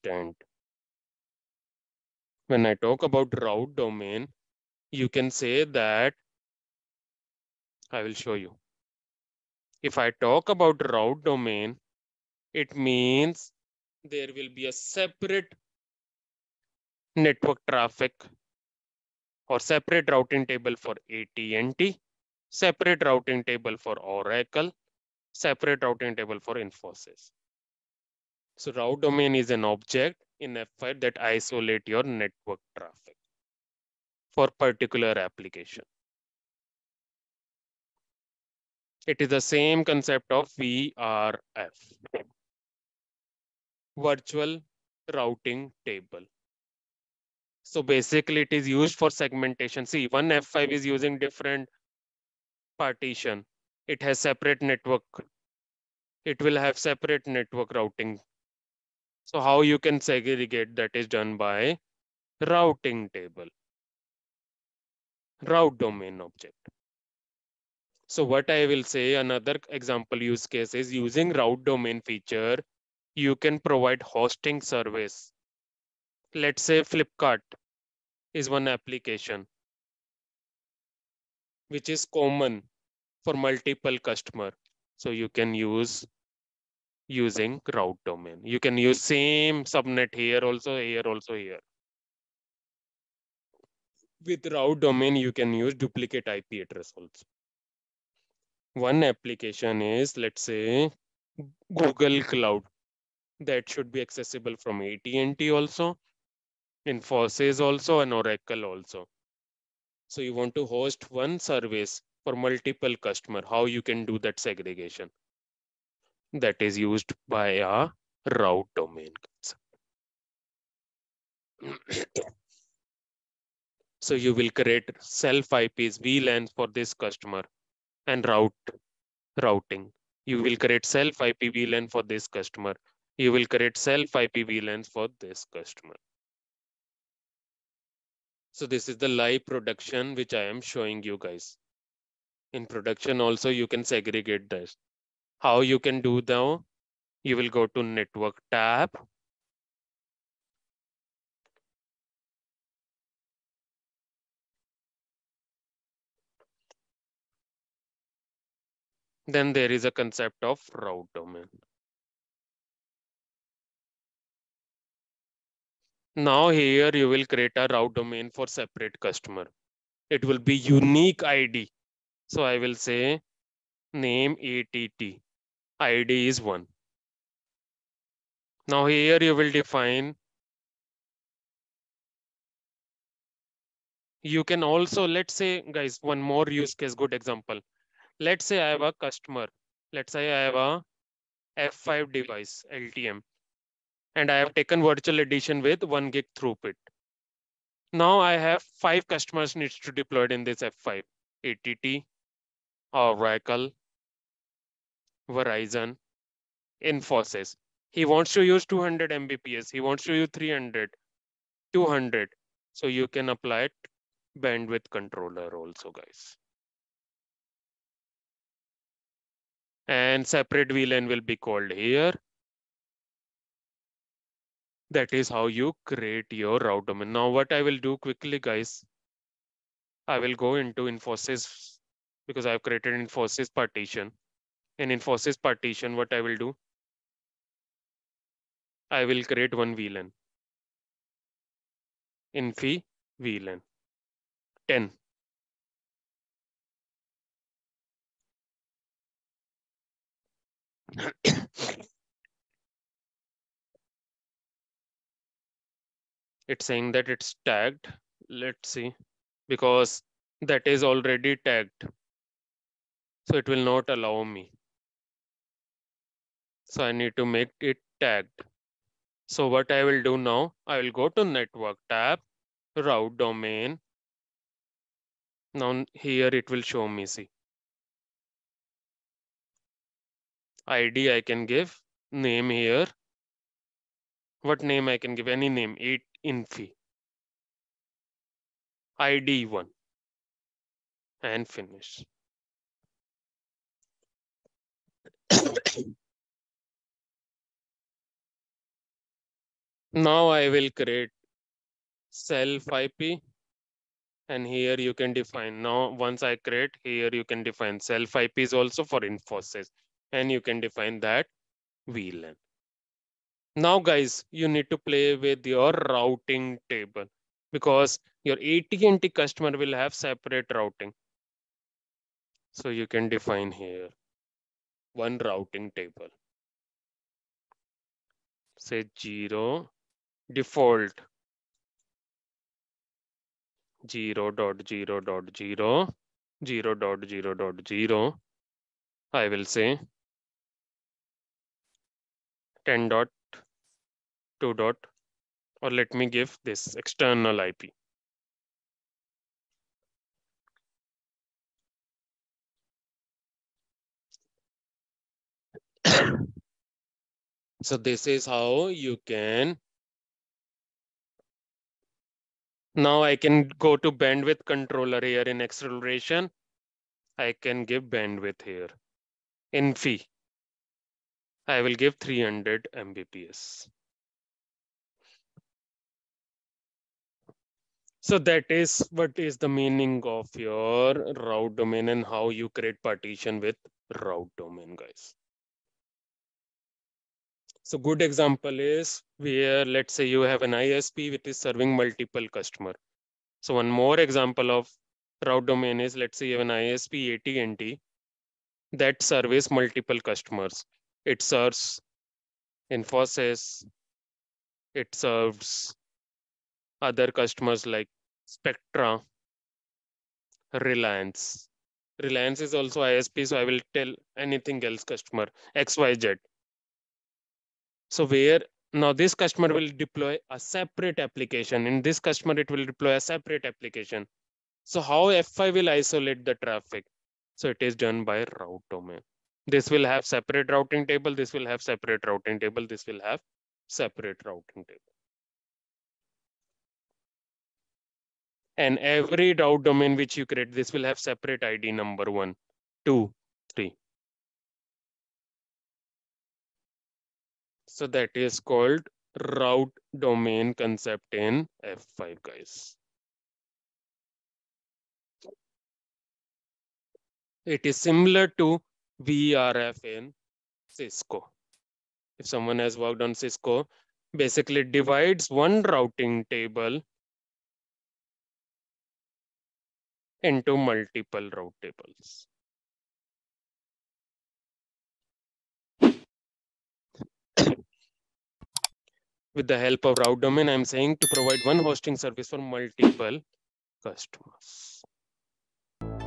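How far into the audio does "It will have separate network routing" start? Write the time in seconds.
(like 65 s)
56 s.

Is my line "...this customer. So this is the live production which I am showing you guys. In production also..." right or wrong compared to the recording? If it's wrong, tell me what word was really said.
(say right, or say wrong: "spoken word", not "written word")
right.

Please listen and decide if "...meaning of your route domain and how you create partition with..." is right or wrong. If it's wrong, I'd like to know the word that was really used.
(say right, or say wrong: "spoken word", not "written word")
right.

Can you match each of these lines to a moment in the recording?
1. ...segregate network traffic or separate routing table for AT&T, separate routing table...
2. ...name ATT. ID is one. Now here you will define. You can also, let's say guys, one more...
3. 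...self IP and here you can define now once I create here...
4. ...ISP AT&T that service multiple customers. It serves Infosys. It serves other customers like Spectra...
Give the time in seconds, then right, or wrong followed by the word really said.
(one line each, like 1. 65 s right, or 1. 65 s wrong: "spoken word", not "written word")
1. 14 s wrong: "separate", not "segregate"
2. 173 s right
3. 302 s right
4. 396 s right.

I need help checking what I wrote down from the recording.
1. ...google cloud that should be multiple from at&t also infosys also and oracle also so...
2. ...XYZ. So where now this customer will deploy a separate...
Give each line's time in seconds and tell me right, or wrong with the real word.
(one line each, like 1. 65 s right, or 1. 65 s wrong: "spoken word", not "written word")
1. 101 s wrong: "accessible", not "multiple"
2. 415 s right.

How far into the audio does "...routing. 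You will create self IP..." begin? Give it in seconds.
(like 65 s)
129 s.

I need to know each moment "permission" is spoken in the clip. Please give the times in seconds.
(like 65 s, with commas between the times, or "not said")
not said.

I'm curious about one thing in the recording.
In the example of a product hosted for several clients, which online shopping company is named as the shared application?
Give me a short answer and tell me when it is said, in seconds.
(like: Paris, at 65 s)
Flipkart, at 76 s.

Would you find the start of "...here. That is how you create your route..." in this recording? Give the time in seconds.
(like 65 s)
221 s.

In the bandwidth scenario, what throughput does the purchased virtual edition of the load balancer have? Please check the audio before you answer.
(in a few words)
1 gig.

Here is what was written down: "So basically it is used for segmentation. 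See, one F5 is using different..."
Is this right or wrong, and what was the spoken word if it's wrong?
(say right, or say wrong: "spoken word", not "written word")
right.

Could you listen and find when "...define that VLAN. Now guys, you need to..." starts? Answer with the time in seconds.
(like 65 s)
310 s.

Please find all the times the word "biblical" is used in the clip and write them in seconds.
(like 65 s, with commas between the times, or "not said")
not said.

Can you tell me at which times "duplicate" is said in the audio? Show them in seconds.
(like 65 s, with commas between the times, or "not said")
95 s.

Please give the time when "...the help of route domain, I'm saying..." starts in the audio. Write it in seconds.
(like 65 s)
479 s.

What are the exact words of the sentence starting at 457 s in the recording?
It is similar to VRF in Cisco.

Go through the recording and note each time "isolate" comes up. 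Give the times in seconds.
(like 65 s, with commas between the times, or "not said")
31 s, 425 s.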